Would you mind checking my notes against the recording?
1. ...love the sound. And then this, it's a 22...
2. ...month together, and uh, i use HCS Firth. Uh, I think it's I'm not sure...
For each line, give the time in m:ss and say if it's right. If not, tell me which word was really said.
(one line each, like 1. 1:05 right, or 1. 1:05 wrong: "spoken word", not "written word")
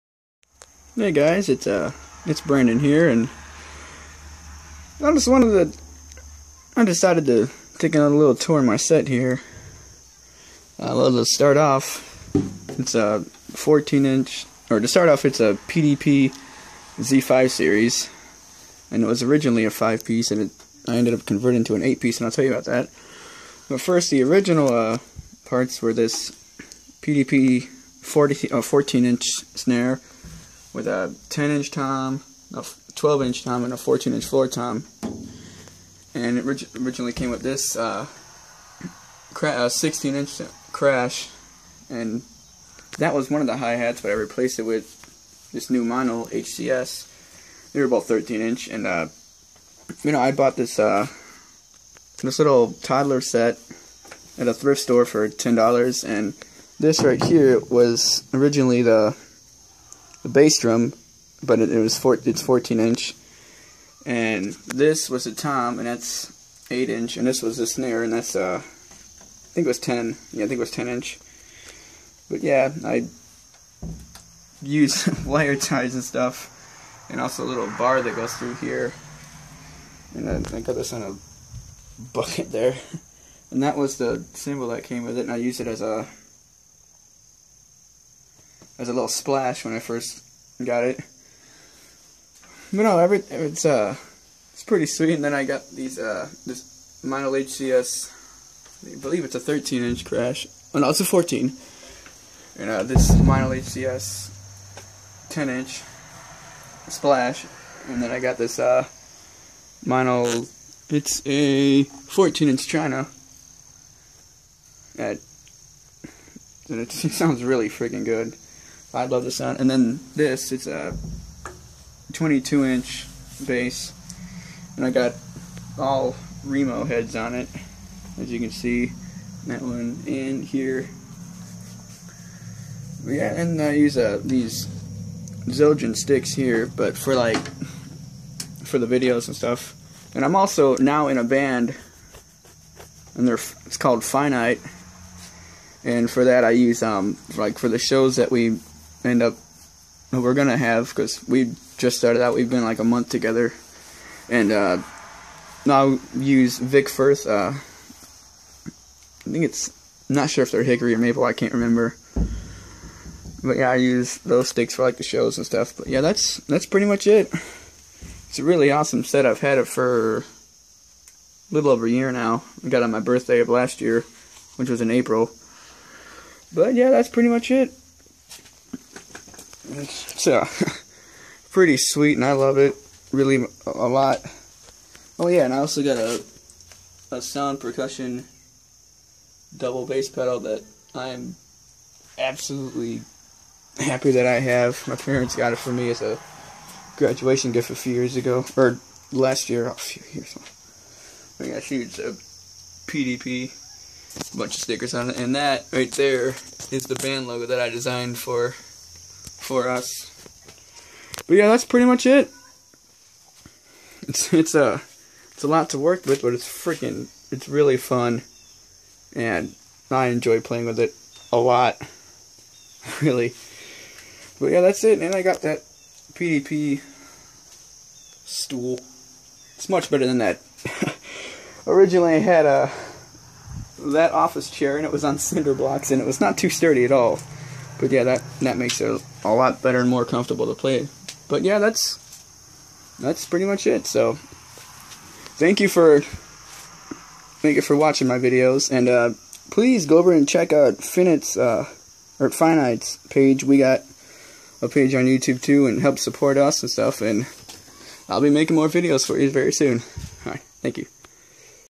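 1. 1:59 right
2. 2:32 wrong: "Vic", not "HCS".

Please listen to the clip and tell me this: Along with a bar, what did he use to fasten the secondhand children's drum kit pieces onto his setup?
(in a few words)
wire ties.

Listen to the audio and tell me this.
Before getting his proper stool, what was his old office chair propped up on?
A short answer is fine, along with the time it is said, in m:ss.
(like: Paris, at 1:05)
cinder blocks, at 3:55.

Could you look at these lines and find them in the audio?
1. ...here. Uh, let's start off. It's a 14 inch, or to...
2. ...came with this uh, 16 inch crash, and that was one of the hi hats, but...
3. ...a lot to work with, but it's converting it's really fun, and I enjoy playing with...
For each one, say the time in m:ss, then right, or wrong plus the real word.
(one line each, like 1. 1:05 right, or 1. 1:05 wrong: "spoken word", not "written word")
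1. 0:09 right
2. 0:37 right
3. 3:35 wrong: "freaking", not "converting".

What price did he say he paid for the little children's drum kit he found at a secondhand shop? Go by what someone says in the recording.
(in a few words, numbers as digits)
$10.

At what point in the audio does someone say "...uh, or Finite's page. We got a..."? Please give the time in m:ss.
4:11.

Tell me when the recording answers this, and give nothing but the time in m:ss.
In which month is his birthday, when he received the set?
2:54.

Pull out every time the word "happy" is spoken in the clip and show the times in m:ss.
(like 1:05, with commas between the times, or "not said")
3:13.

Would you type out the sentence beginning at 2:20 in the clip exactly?
And I'm also now in a band, and they're it's called Finite.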